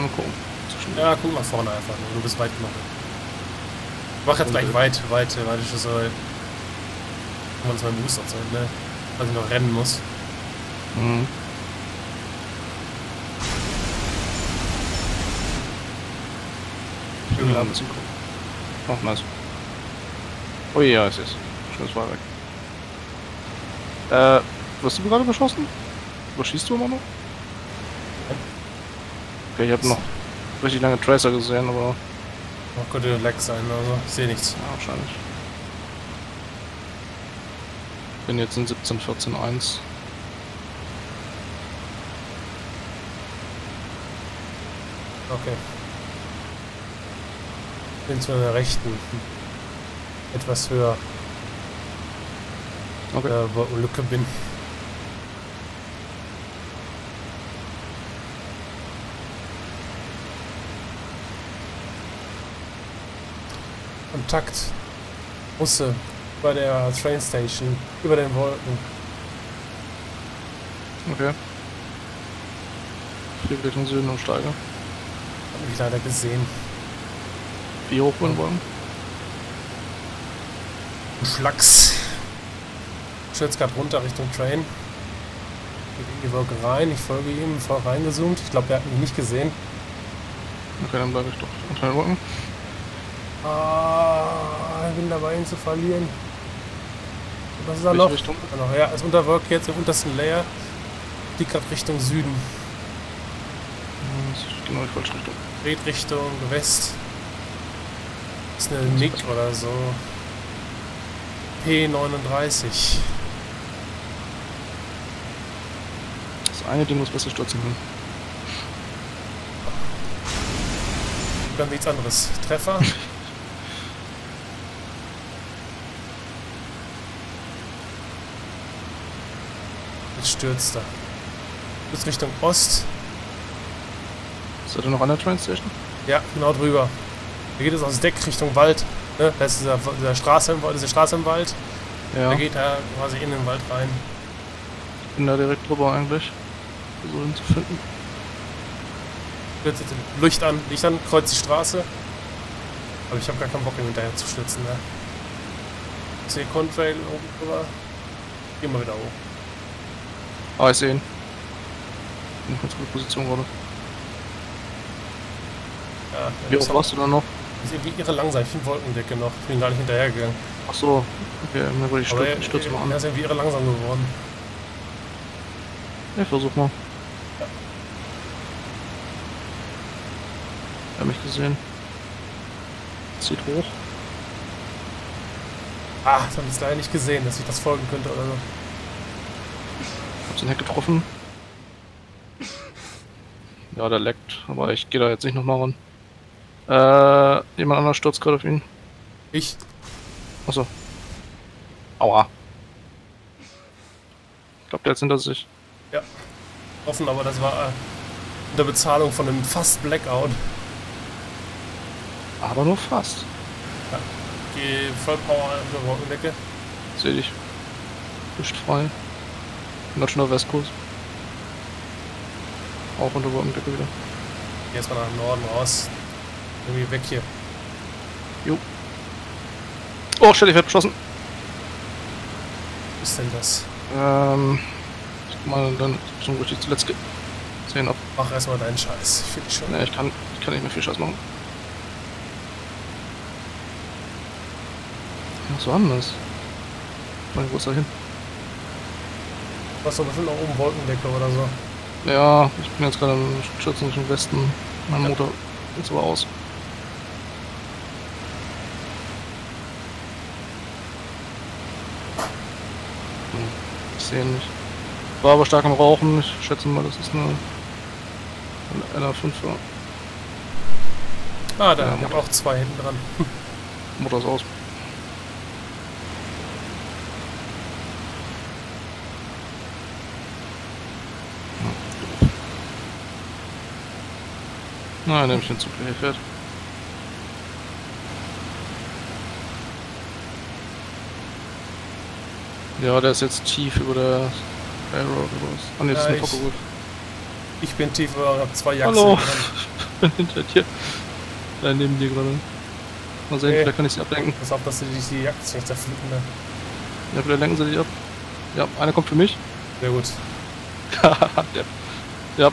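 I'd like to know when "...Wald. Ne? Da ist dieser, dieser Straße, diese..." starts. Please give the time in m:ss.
2:18.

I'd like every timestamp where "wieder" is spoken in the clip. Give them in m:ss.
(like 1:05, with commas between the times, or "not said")
2:38, 3:43.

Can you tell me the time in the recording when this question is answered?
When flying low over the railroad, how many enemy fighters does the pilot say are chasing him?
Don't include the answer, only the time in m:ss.
4:58.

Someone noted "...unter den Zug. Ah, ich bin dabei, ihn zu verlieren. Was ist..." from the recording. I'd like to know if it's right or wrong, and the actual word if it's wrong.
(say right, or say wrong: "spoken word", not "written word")
wrong: "Wolken", not "Zug".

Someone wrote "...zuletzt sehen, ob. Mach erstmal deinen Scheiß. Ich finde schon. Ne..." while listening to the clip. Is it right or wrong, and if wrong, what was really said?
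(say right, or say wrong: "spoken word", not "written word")
right.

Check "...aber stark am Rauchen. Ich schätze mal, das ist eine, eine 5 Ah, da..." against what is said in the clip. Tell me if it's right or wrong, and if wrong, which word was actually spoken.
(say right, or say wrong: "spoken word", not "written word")
right.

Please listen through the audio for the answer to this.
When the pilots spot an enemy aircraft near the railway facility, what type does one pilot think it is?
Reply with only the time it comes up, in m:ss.
1:51.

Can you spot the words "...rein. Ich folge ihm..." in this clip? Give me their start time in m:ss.
1:26.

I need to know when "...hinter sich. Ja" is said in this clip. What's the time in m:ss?
3:24.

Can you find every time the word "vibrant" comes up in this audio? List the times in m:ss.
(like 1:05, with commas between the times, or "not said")
not said.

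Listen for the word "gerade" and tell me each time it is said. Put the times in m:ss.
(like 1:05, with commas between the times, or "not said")
0:25, 1:23, 1:41, 2:43, 3:18, 4:12, 5:02.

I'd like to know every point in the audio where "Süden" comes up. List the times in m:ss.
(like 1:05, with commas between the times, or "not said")
1:13, 1:41.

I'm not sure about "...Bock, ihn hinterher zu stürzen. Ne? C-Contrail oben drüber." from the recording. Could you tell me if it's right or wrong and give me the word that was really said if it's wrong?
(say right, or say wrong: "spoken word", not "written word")
right.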